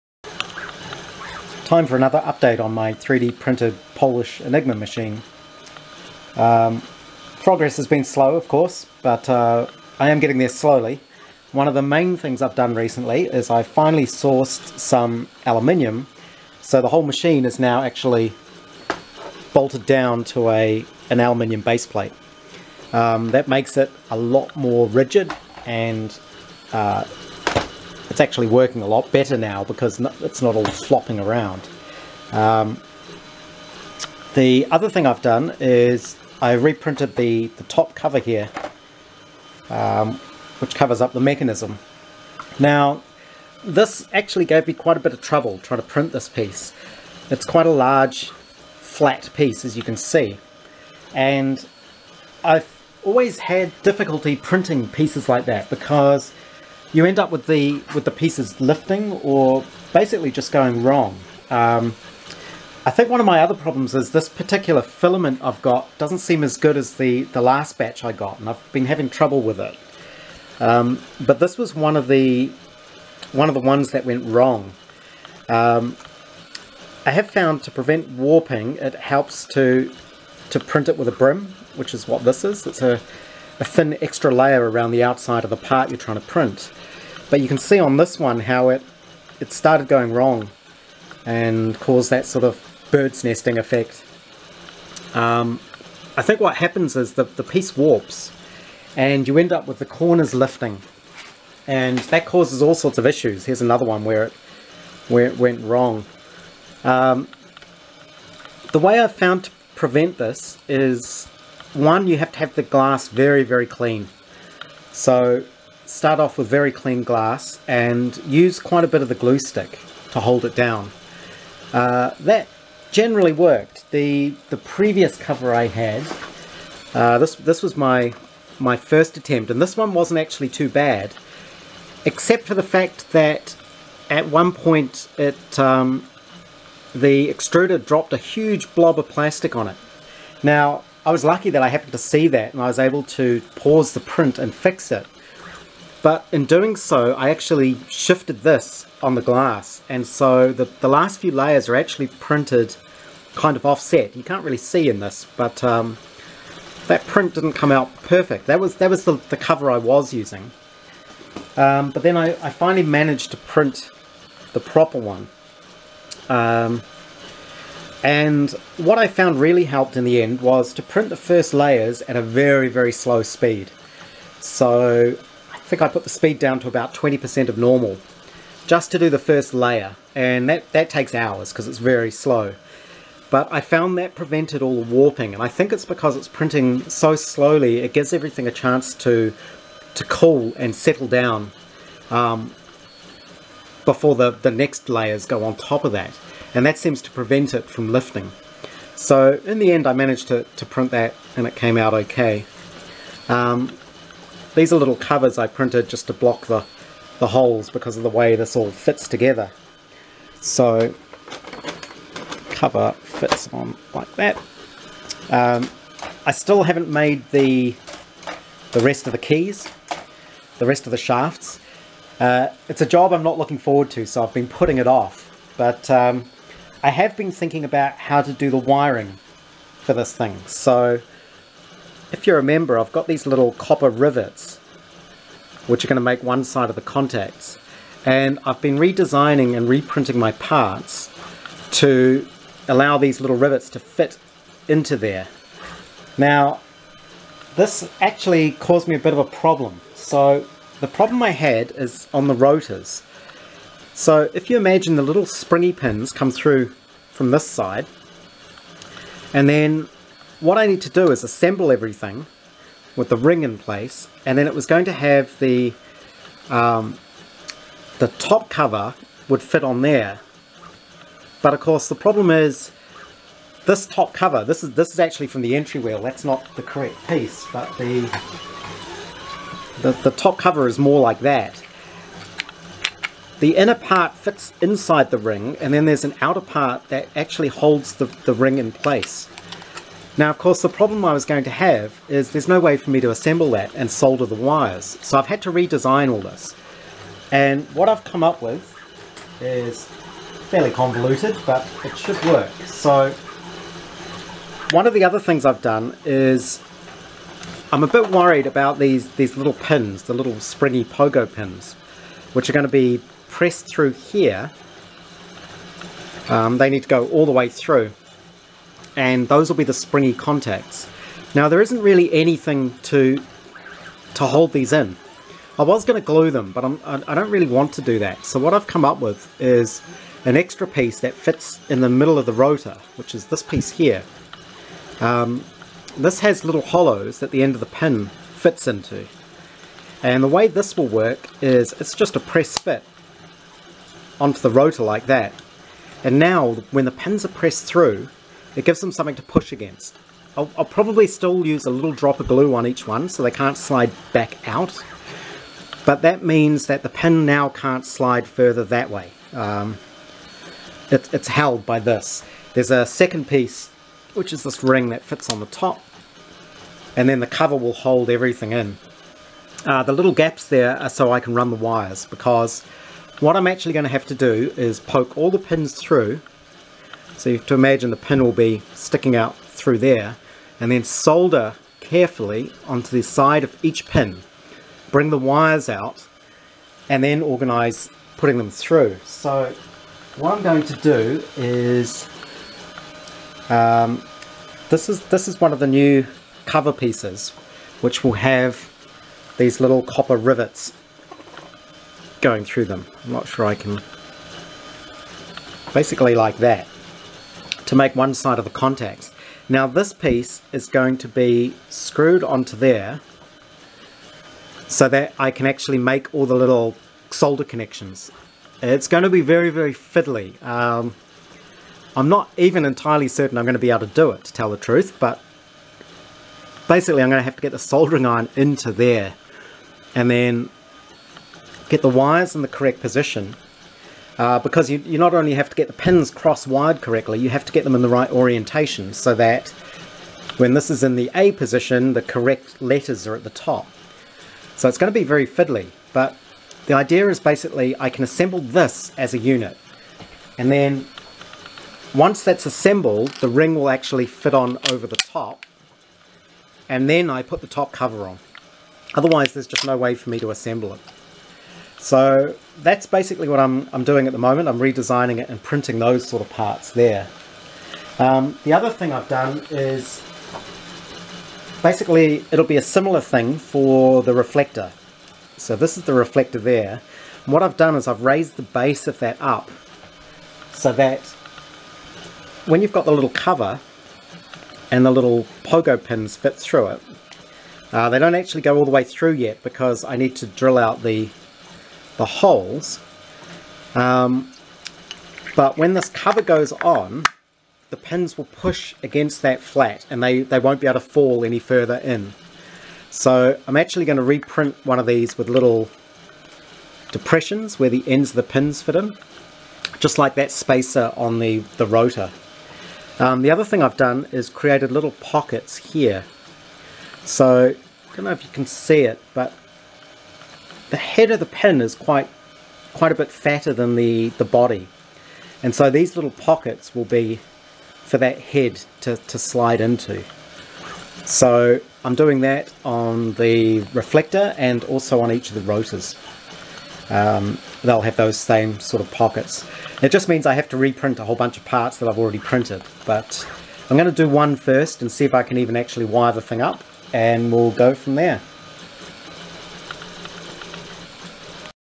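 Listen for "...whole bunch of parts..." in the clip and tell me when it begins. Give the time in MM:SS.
09:01.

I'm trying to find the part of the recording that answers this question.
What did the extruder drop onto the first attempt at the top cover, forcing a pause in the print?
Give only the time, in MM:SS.
02:18.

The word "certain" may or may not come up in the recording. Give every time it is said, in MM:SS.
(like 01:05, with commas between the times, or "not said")
07:03.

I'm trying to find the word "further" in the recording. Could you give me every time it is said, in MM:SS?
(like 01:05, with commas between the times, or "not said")
05:58, 08:21.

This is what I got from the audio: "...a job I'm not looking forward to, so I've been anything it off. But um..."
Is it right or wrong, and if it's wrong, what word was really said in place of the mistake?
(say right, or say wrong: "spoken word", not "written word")
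wrong: "putting", not "anything".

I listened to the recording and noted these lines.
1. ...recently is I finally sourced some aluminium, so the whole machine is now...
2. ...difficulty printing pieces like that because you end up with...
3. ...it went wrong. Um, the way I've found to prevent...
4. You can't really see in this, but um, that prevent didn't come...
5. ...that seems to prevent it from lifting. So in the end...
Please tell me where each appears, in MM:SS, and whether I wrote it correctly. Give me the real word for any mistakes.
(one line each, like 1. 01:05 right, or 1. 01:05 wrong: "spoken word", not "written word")
1. 00:12 right
2. 00:53 right
3. 01:45 right
4. 02:34 wrong: "print", not "prevent"
5. 03:16 right.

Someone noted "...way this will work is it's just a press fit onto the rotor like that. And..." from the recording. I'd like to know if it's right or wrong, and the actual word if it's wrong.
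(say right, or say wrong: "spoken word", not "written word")
right.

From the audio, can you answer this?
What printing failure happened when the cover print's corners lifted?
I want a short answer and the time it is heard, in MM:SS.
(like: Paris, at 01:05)
Bird's nesting, at 01:32.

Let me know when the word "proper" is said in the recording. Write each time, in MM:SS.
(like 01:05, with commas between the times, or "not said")
02:44.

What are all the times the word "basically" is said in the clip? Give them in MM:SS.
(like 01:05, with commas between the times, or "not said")
00:59, 06:45, 07:06, 07:27, 07:42, 07:51.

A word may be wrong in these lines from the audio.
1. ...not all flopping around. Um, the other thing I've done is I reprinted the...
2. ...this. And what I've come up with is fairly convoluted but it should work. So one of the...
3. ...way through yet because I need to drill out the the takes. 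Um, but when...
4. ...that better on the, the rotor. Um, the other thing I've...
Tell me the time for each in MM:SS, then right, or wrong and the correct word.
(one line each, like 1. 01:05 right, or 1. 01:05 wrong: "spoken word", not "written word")
1. 00:30 right
2. 04:56 right
3. 08:08 wrong: "holes", not "takes"
4. 08:30 wrong: "spacer", not "better".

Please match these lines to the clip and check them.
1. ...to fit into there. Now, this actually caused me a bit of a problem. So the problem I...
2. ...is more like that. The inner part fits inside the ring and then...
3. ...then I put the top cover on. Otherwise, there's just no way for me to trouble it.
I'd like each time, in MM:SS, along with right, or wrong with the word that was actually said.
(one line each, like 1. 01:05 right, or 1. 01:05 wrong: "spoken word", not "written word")
1. 04:03 right
2. 04:40 right
3. 07:36 wrong: "assemble", not "trouble".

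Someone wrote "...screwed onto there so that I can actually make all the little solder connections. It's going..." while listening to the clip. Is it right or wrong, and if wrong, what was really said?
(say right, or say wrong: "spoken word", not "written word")
right.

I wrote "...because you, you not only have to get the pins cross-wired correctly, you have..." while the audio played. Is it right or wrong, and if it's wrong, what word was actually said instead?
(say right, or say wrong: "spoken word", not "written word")
right.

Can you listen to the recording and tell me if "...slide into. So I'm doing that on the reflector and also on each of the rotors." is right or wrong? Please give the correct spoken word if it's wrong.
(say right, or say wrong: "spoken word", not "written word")
right.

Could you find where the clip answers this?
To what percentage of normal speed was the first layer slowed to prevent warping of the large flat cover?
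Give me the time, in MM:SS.
02:56.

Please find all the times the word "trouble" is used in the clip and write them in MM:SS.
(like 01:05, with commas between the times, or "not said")
00:45, 01:09.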